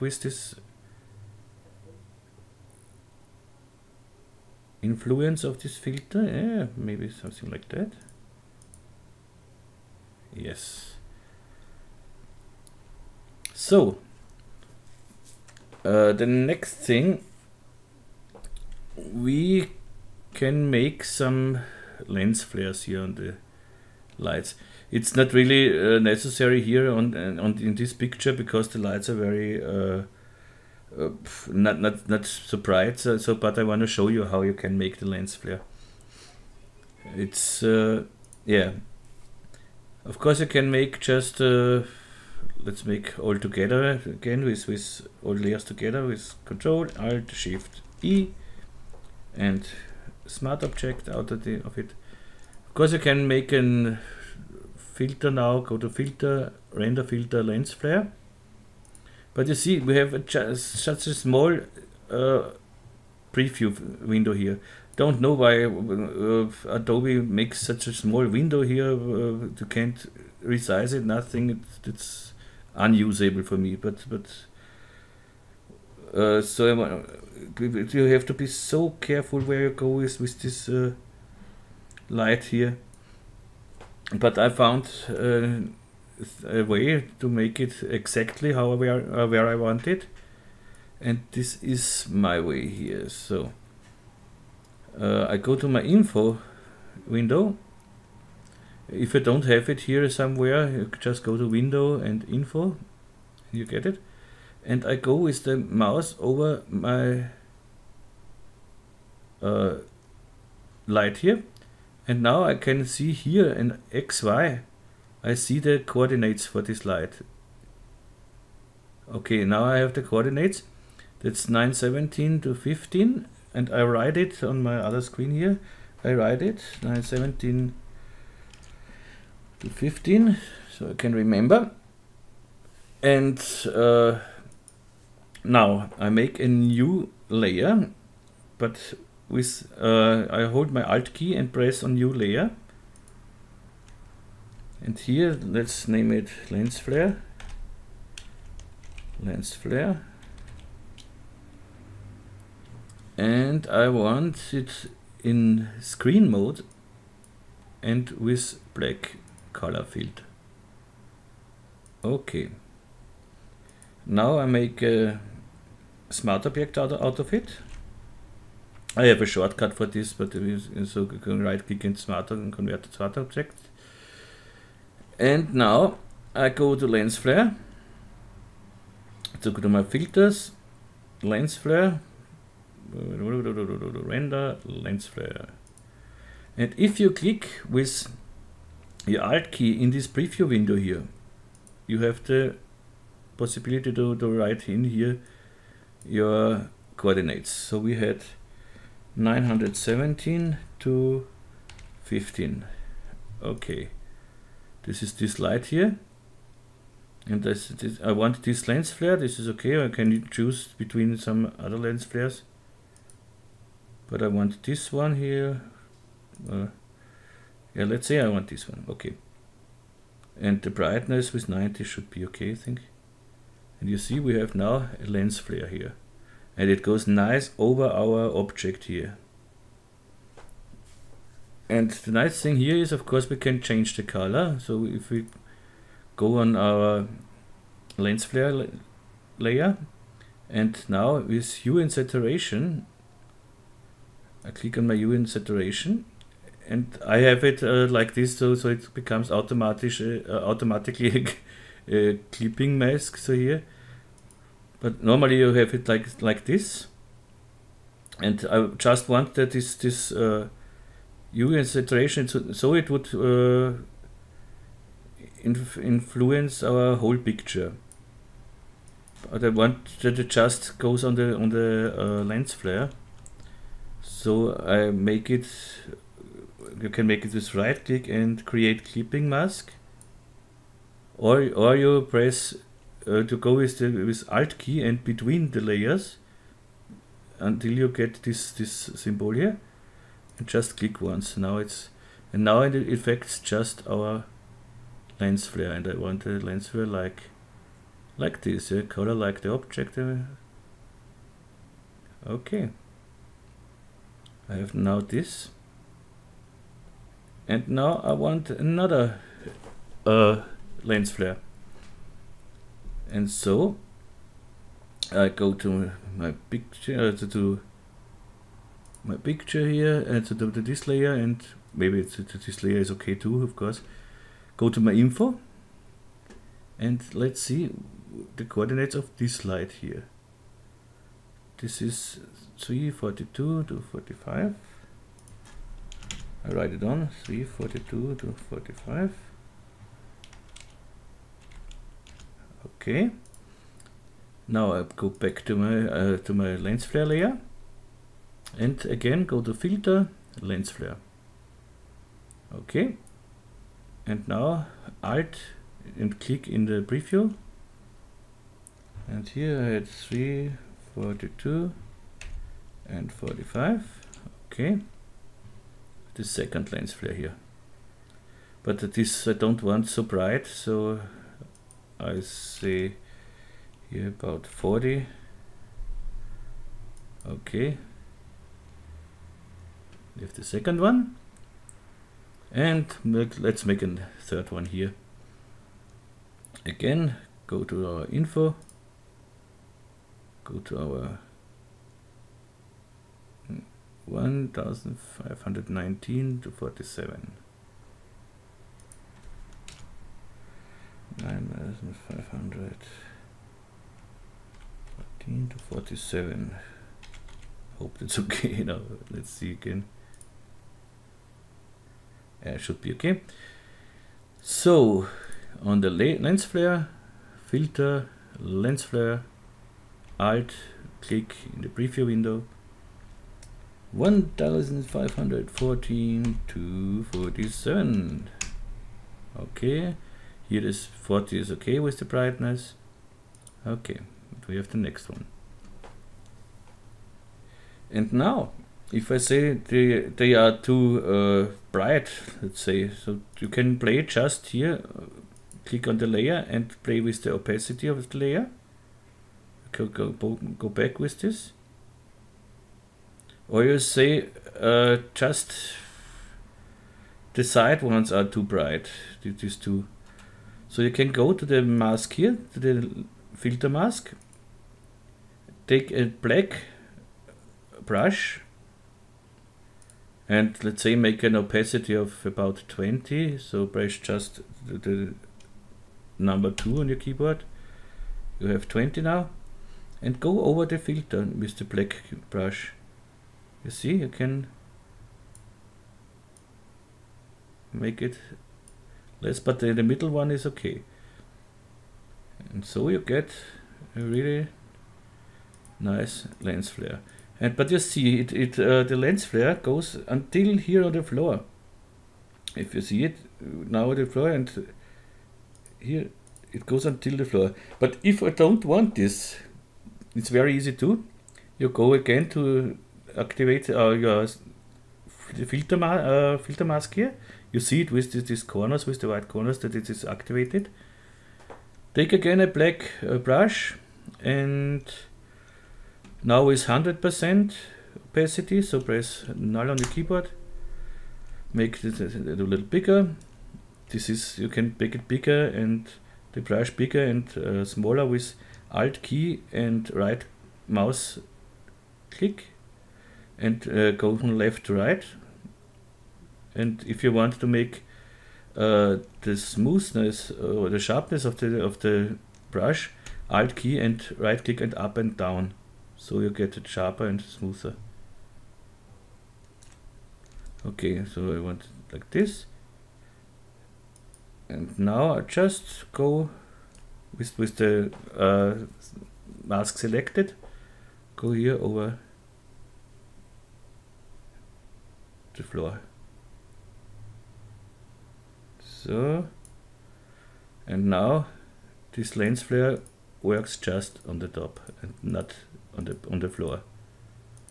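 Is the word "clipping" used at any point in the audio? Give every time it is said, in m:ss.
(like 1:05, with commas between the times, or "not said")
4:12, 4:38.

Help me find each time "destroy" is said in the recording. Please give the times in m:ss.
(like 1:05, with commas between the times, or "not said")
not said.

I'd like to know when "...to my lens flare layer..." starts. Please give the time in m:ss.
5:46.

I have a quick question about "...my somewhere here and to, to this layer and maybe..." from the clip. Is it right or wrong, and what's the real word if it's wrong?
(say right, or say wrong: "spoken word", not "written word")
wrong: "picture", not "somewhere".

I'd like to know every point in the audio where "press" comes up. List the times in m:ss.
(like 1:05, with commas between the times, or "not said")
2:21, 4:42, 7:53, 8:48.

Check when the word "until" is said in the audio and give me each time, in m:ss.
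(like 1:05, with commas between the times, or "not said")
4:47, 8:20, 8:26.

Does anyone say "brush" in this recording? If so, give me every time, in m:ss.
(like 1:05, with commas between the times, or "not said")
7:47, 8:02, 8:43, 8:56, 9:12.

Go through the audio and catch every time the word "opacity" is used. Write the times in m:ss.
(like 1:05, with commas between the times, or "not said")
7:27, 7:51, 8:48.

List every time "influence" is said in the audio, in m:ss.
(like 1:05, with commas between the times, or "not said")
0:04, 4:25.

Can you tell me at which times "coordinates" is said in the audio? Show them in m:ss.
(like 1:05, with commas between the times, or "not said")
1:55, 2:00, 3:16, 5:28.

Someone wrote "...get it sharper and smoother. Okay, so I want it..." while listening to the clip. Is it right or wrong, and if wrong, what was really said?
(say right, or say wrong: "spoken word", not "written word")
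right.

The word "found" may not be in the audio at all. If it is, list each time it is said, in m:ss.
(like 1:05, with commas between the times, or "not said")
1:24.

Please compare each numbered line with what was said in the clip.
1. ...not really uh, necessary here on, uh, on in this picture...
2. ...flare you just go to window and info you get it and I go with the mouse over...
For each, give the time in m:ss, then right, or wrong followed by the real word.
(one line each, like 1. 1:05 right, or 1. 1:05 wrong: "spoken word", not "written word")
1. 0:25 right
2. 1:40 wrong: "somewhere", not "flare".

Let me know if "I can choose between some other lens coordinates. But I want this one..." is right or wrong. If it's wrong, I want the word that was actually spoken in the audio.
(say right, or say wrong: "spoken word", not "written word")
wrong: "flares", not "coordinates".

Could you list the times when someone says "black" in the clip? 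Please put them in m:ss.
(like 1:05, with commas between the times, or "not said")
2:38, 7:46, 8:01, 8:42.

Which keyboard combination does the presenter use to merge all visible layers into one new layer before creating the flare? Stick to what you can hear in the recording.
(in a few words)
Control Alt Shift E.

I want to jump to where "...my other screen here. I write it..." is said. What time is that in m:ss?
2:04.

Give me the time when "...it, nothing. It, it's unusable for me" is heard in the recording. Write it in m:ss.
1:10.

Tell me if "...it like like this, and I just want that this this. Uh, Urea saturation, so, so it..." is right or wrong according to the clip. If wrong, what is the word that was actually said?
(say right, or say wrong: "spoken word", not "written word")
right.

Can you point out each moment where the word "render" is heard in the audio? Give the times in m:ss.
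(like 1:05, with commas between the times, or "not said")
0:56, 3:02.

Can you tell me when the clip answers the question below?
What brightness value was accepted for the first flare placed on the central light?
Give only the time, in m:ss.
3:41.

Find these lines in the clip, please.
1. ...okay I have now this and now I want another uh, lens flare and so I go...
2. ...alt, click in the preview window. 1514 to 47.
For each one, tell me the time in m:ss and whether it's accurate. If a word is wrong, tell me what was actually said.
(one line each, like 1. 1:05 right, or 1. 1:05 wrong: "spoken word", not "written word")
1. 5:02 right
2. 7:00 right.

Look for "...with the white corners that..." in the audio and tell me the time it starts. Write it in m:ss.
8:38.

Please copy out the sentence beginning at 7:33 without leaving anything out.
Or you say uh, just the side ones are too bright, these two.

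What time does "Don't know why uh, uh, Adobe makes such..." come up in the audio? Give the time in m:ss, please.
1:04.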